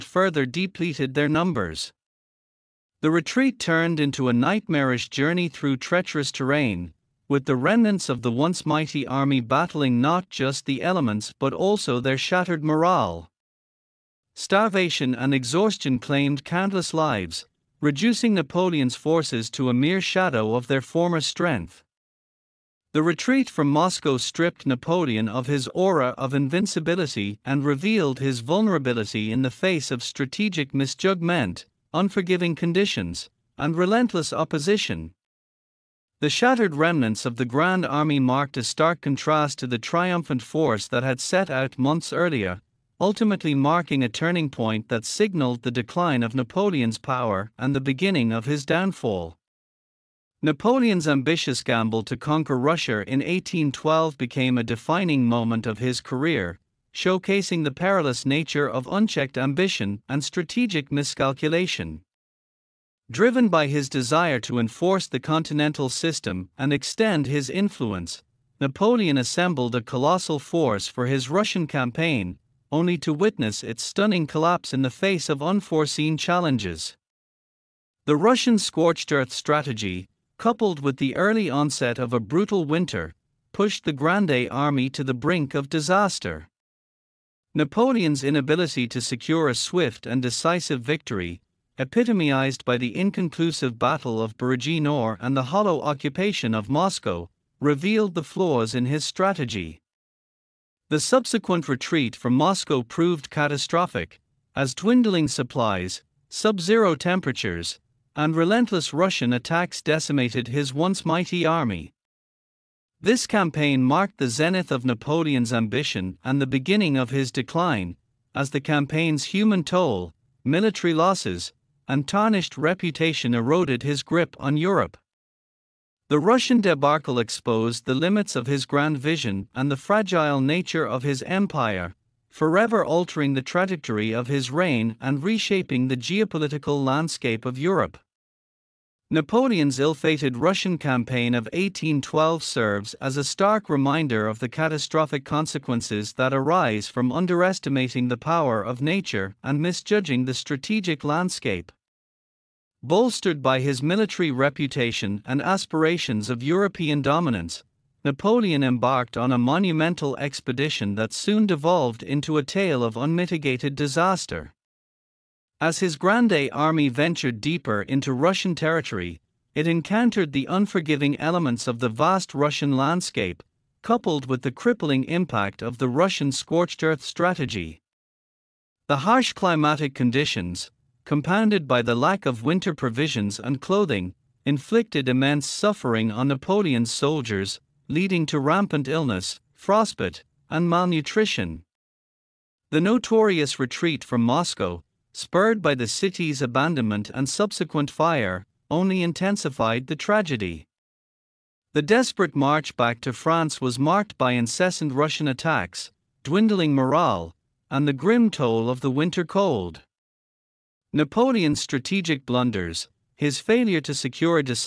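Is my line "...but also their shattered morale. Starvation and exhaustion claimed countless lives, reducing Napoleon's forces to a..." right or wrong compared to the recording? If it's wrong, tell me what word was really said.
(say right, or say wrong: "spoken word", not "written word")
right.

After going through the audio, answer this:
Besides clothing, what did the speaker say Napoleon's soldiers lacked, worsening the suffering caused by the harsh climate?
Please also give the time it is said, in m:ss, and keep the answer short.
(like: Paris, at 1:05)
Winter provisions, at 3:02.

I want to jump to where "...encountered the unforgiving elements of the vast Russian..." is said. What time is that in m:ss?
2:49.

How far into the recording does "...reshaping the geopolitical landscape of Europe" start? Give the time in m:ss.
2:15.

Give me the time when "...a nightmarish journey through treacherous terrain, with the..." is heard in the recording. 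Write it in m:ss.
0:04.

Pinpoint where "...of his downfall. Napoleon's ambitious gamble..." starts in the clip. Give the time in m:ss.
0:48.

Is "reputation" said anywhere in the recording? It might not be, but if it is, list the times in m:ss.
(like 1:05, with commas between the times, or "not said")
2:02, 2:34.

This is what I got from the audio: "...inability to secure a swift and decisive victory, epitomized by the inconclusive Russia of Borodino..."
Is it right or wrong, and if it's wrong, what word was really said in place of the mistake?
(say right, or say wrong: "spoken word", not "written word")
wrong: "Battle", not "Russia".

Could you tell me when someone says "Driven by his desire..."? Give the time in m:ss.
1:03.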